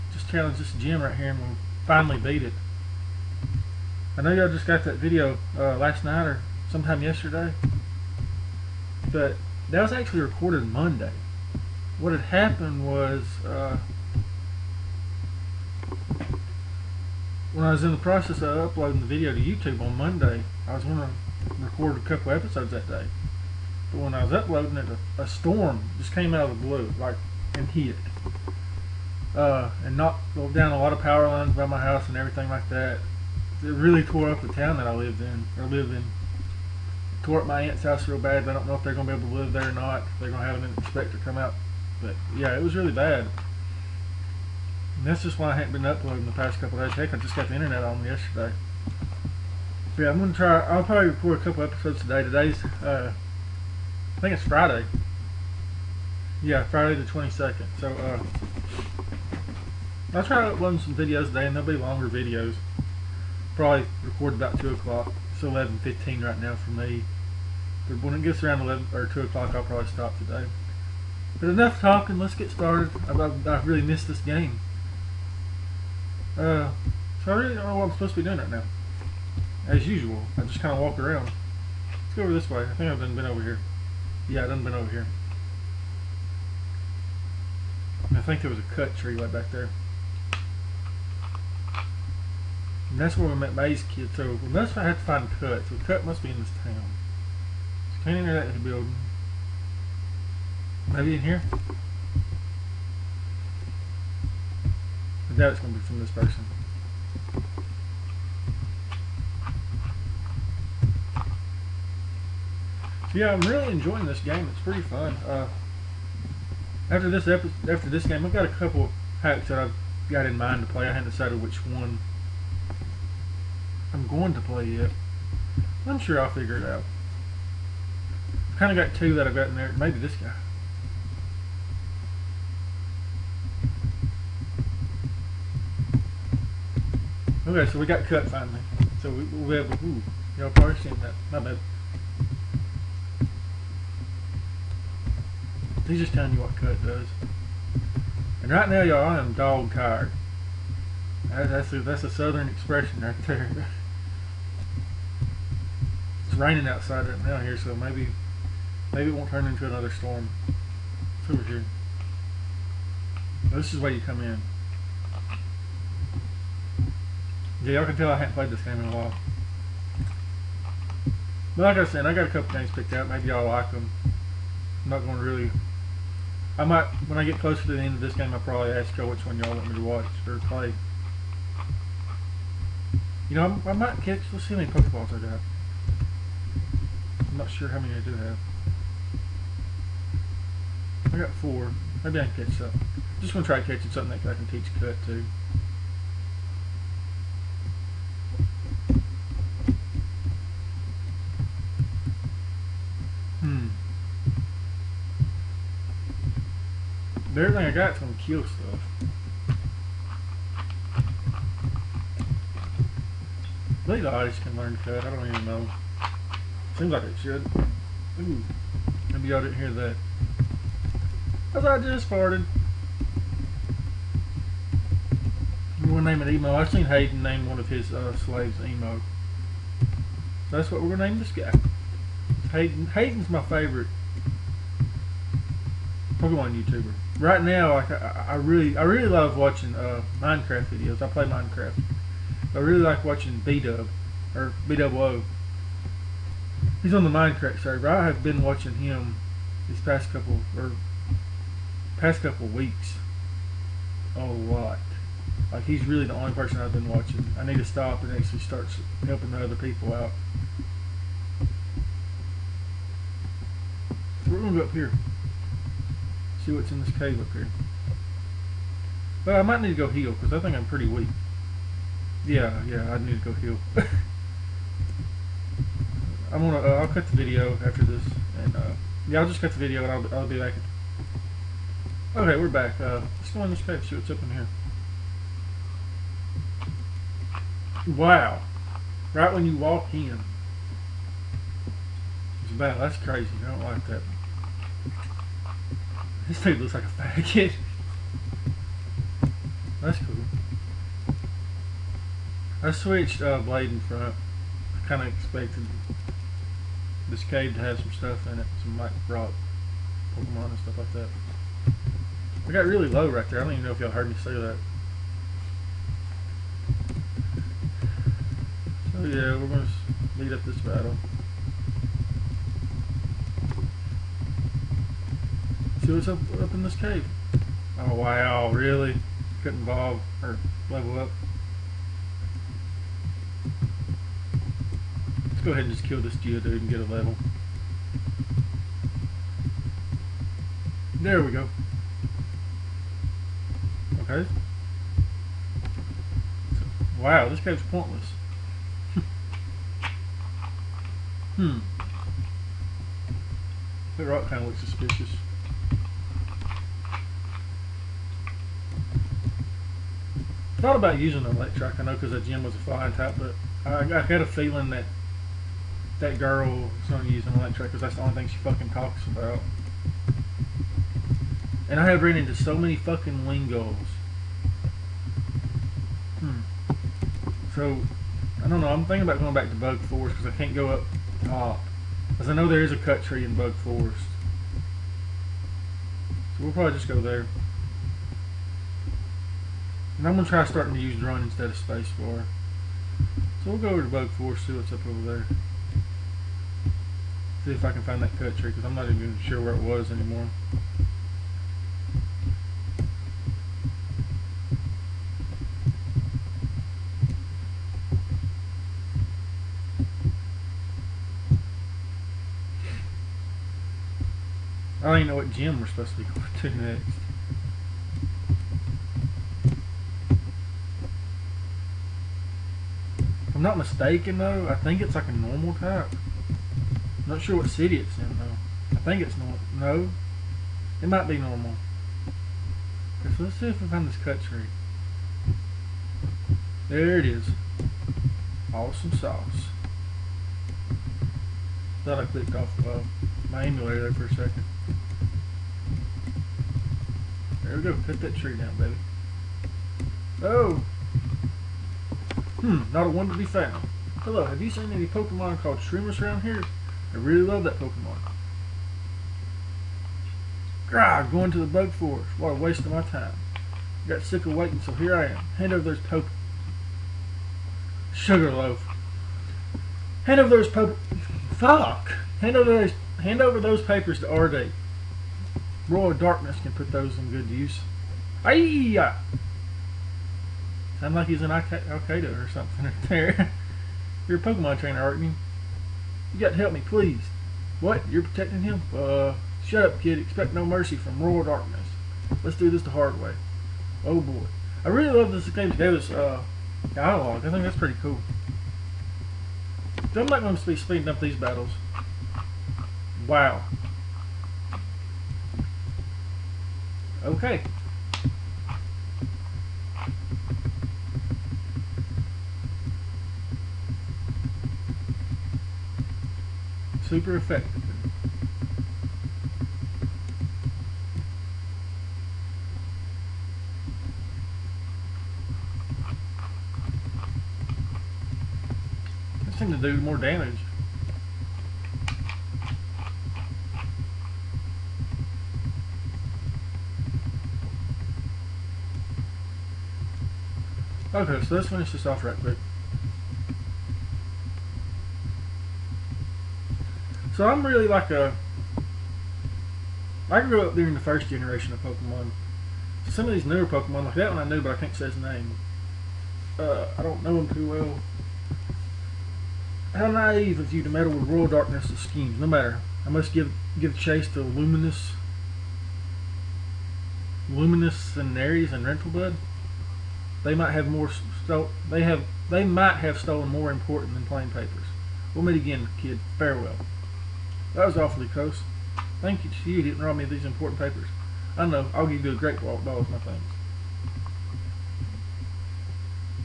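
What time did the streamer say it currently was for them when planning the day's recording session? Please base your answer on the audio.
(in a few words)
11:15.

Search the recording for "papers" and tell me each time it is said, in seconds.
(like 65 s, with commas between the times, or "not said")
473 s, 574 s, 580 s.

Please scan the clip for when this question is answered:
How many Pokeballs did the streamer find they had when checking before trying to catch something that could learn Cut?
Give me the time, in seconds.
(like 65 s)
191 s.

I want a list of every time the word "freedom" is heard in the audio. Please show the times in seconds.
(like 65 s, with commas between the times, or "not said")
not said.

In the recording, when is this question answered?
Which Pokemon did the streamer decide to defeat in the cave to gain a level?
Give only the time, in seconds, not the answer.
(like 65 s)
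336 s.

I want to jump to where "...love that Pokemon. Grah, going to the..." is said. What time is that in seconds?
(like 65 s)
457 s.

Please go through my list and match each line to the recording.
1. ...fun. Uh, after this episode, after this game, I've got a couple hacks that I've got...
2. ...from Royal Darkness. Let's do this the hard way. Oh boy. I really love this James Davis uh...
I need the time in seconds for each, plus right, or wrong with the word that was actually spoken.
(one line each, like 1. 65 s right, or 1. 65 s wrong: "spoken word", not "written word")
1. 114 s right
2. 490 s right.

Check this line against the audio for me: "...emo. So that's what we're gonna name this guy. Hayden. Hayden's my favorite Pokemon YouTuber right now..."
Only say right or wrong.
right.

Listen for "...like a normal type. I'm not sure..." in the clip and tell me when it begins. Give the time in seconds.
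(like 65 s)
424 s.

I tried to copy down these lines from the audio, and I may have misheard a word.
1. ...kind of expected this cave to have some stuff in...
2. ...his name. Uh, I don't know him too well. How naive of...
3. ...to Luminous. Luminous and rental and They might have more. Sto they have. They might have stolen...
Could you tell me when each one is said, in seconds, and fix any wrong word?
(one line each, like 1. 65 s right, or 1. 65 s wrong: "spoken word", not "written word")
1. 304 s right
2. 554 s right
3. 564 s right.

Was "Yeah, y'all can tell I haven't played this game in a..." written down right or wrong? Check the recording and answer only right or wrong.
right.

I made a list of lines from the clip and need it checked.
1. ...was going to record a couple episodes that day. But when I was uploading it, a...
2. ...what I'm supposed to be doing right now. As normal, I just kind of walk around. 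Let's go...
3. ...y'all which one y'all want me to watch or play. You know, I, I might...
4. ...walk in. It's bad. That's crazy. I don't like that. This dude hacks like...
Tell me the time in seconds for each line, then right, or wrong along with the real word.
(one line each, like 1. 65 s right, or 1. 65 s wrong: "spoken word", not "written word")
1. 20 s right
2. 77 s wrong: "usual", not "normal"
3. 178 s right
4. 289 s wrong: "looks", not "hacks".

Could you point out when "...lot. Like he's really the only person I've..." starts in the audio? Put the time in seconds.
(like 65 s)
254 s.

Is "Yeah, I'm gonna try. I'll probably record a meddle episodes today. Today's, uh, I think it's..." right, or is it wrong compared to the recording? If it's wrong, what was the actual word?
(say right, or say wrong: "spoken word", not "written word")
wrong: "couple", not "meddle".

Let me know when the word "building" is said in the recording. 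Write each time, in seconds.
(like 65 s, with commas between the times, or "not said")
98 s.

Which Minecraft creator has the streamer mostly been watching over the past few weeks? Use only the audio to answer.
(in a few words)
B Dub.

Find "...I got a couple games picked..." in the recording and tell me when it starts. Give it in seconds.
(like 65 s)
172 s.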